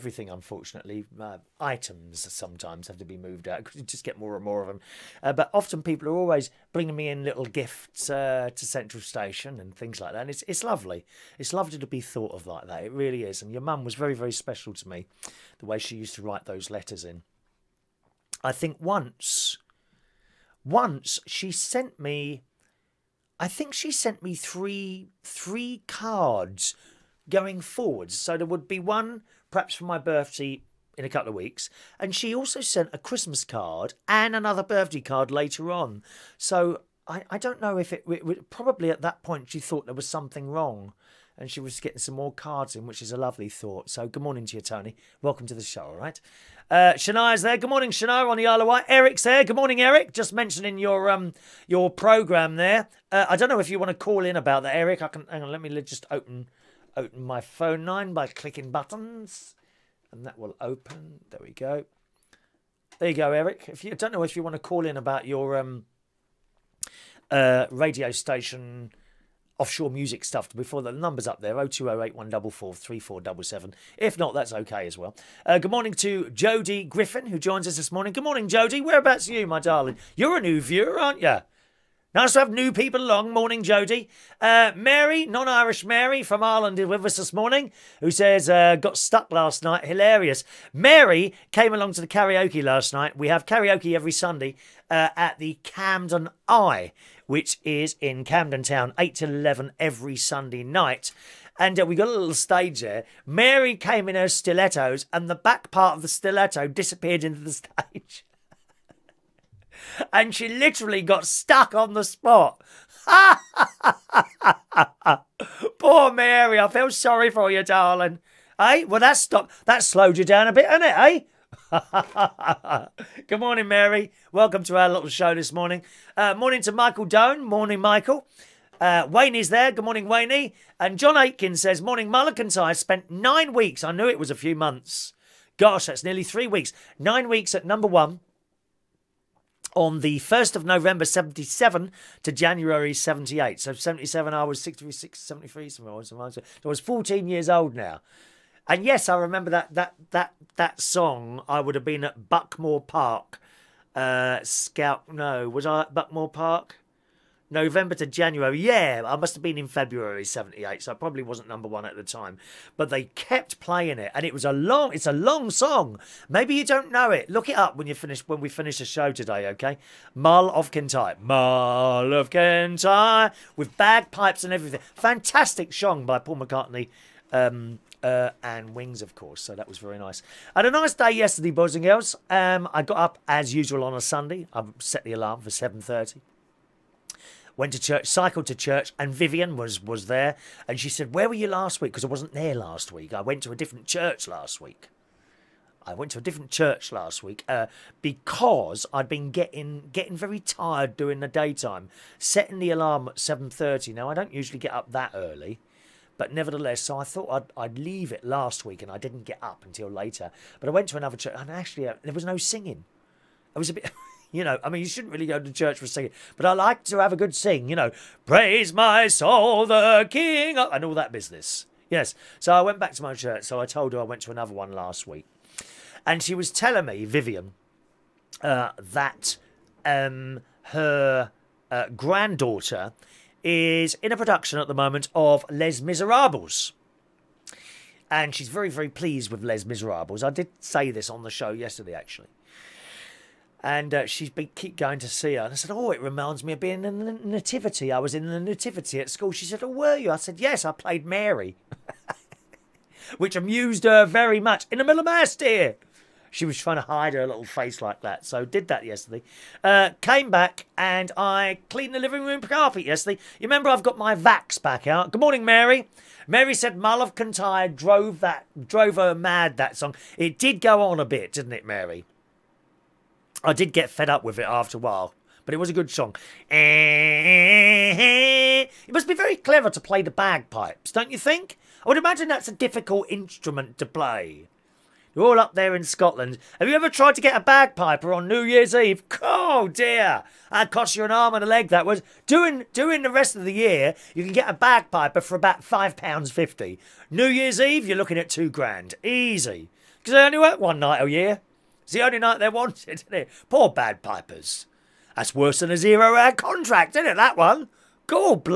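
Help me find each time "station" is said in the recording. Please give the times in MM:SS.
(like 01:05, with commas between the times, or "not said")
00:09, 01:08.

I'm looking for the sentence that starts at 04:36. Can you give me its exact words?
It must be very clever to play the bagpipes, don't you think?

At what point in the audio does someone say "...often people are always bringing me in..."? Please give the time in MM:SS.
00:05.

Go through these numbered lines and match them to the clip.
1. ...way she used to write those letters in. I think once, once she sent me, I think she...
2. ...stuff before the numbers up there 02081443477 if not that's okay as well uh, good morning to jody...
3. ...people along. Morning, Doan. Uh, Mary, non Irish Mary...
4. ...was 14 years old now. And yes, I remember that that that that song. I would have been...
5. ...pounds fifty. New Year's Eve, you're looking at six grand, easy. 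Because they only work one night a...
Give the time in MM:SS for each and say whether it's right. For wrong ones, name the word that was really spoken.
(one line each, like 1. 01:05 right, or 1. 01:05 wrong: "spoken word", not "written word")
1. 00:15 right
2. 01:10 right
3. 01:22 wrong: "Jody", not "Doan"
4. 02:26 right
5. 04:55 wrong: "two", not "six".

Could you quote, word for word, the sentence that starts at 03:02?
Um, I got up as usual on a Sunday.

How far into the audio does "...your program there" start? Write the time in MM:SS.
00:51.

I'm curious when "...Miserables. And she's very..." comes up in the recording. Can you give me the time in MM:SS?
03:55.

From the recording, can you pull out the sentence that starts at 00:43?
So good morning to you, Tony.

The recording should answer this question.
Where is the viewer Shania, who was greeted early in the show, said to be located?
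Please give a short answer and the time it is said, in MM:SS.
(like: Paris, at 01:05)
Isle of Wight, at 00:48.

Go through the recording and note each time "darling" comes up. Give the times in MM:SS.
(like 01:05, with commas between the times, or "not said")
01:19, 01:57.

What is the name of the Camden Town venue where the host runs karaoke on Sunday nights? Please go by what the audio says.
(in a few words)
Camden Eye.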